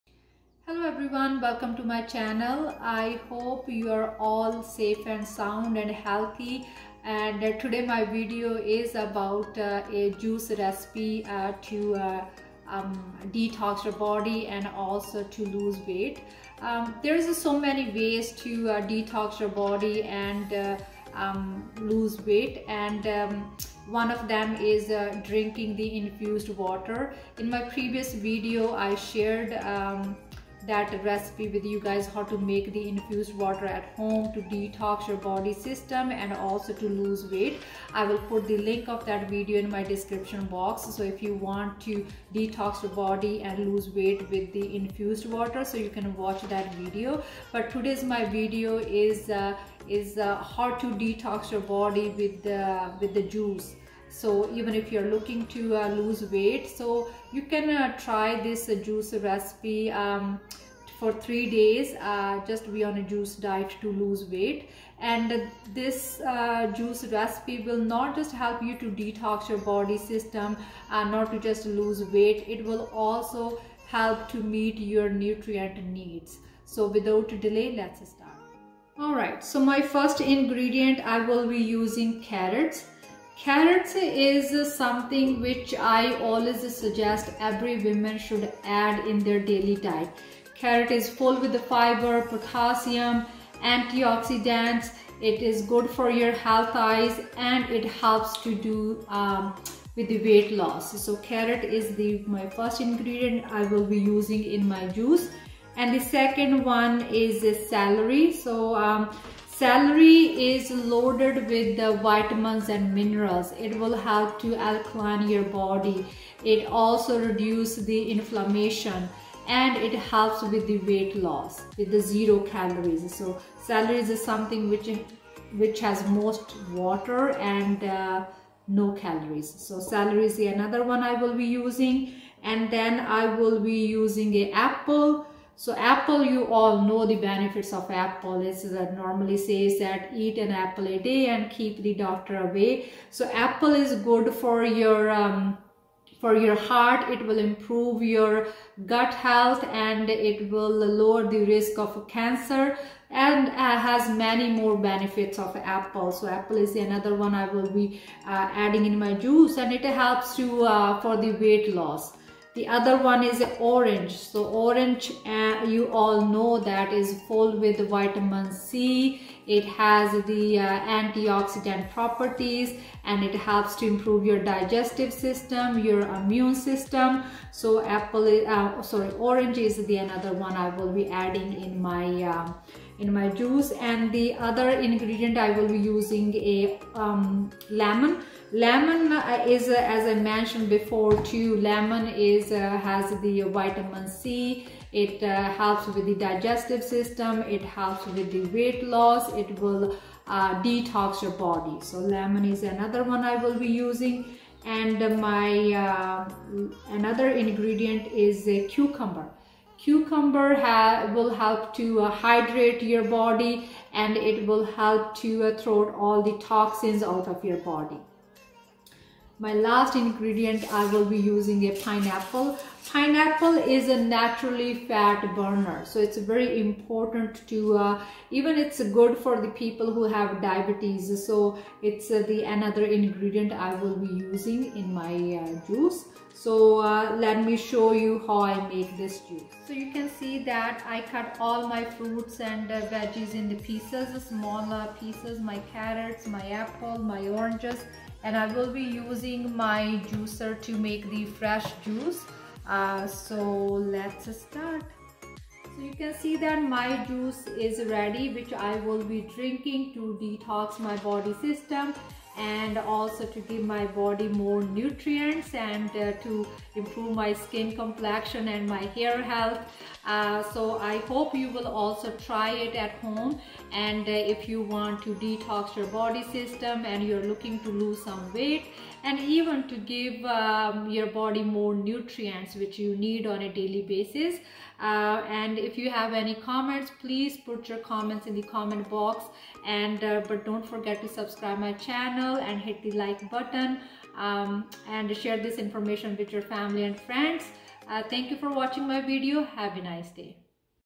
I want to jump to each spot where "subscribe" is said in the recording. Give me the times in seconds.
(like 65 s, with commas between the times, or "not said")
291 s.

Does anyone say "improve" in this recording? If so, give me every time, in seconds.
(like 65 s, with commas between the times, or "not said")
147 s, 173 s, 266 s.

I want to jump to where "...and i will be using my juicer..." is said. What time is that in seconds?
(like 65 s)
248 s.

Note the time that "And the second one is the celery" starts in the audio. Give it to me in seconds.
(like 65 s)
105 s.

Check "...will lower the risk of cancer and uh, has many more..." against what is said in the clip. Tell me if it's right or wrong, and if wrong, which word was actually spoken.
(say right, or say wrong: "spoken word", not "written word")
right.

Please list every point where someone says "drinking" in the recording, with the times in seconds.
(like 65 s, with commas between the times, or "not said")
25 s, 259 s.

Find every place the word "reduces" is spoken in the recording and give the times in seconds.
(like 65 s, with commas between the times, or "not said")
117 s.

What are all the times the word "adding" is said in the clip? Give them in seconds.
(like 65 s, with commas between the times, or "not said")
158 s, 181 s.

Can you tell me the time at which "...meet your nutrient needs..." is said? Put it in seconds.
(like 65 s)
74 s.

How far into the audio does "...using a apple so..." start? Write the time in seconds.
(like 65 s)
133 s.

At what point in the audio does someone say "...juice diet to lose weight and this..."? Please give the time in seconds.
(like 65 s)
63 s.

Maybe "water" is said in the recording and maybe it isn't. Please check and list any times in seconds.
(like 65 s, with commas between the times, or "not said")
26 s, 33 s, 45 s, 126 s.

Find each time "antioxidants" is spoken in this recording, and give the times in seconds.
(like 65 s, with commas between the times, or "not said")
93 s, 170 s.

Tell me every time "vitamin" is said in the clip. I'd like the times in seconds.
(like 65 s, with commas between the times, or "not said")
112 s, 167 s, 193 s.